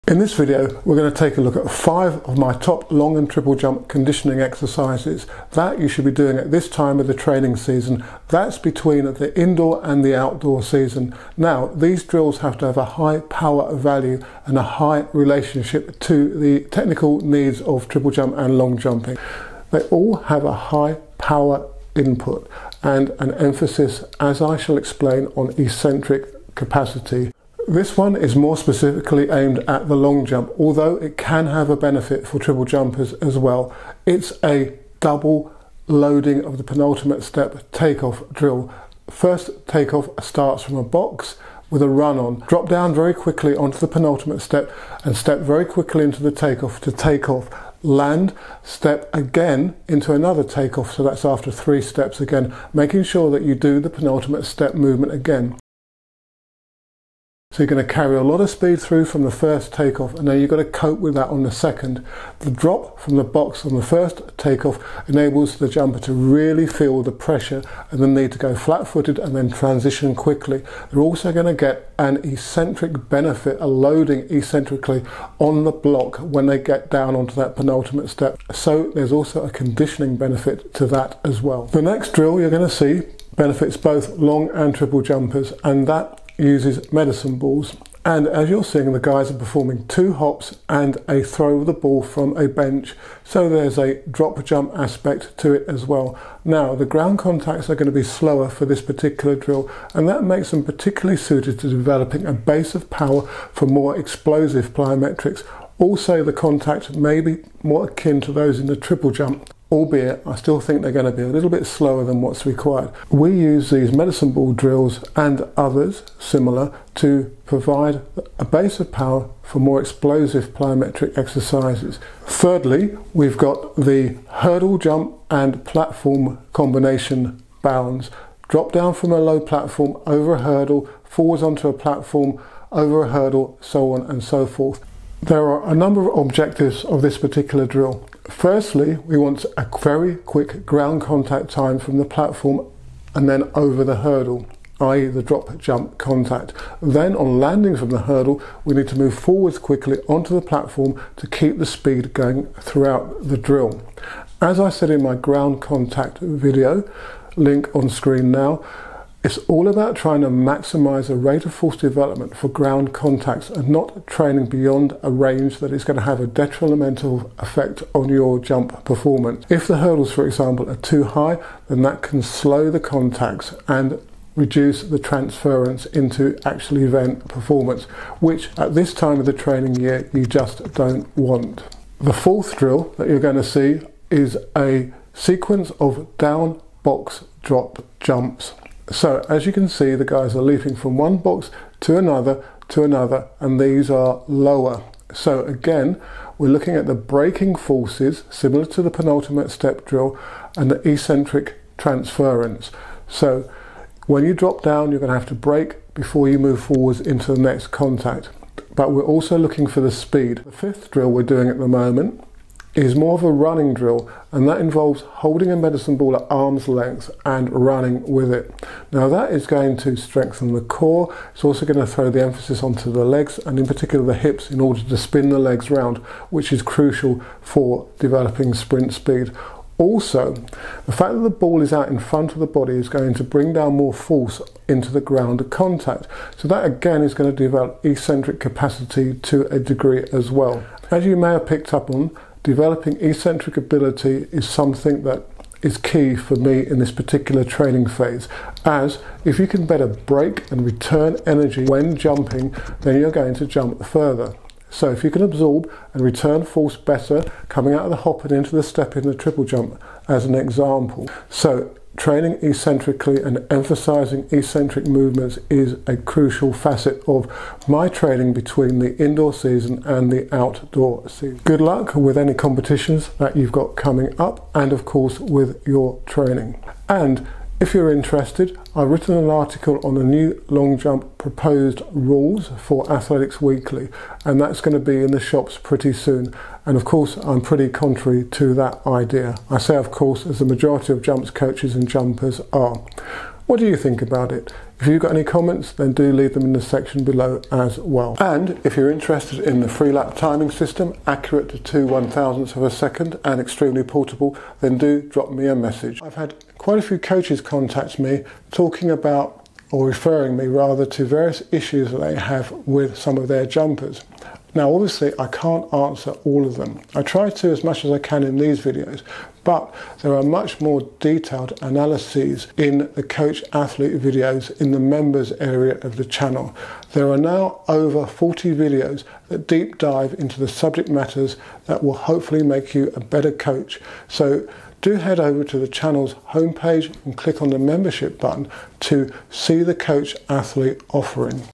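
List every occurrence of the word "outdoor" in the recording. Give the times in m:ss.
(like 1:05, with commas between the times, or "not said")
0:10, 4:30.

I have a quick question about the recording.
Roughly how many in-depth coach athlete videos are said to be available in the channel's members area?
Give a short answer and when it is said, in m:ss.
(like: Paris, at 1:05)
Over 40, at 5:27.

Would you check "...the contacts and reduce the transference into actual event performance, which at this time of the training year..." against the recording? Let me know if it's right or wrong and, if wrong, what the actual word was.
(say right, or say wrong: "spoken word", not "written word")
right.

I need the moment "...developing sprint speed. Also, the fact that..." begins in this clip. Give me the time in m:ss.
3:47.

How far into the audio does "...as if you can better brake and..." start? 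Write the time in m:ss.
4:08.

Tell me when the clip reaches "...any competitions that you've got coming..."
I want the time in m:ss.
4:32.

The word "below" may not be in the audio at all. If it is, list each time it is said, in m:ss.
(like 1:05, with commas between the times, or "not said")
4:57.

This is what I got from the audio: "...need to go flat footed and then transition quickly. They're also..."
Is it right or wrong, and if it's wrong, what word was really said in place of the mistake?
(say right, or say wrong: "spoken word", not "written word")
right.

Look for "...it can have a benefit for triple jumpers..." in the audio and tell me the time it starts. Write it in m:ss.
0:30.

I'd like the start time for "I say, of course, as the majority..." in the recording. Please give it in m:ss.
4:49.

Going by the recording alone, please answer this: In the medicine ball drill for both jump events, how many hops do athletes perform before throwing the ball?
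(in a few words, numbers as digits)
2.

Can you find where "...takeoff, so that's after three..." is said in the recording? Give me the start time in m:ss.
0:50.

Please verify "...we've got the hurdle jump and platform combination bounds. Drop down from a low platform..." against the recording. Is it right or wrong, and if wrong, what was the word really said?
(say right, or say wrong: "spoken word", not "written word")
right.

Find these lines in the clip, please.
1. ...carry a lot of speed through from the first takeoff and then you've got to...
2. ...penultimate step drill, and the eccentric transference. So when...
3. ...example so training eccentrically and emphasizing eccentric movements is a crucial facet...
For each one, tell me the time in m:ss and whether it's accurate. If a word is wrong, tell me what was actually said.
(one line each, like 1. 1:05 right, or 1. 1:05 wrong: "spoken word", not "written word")
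1. 0:57 right
2. 3:18 right
3. 4:20 right.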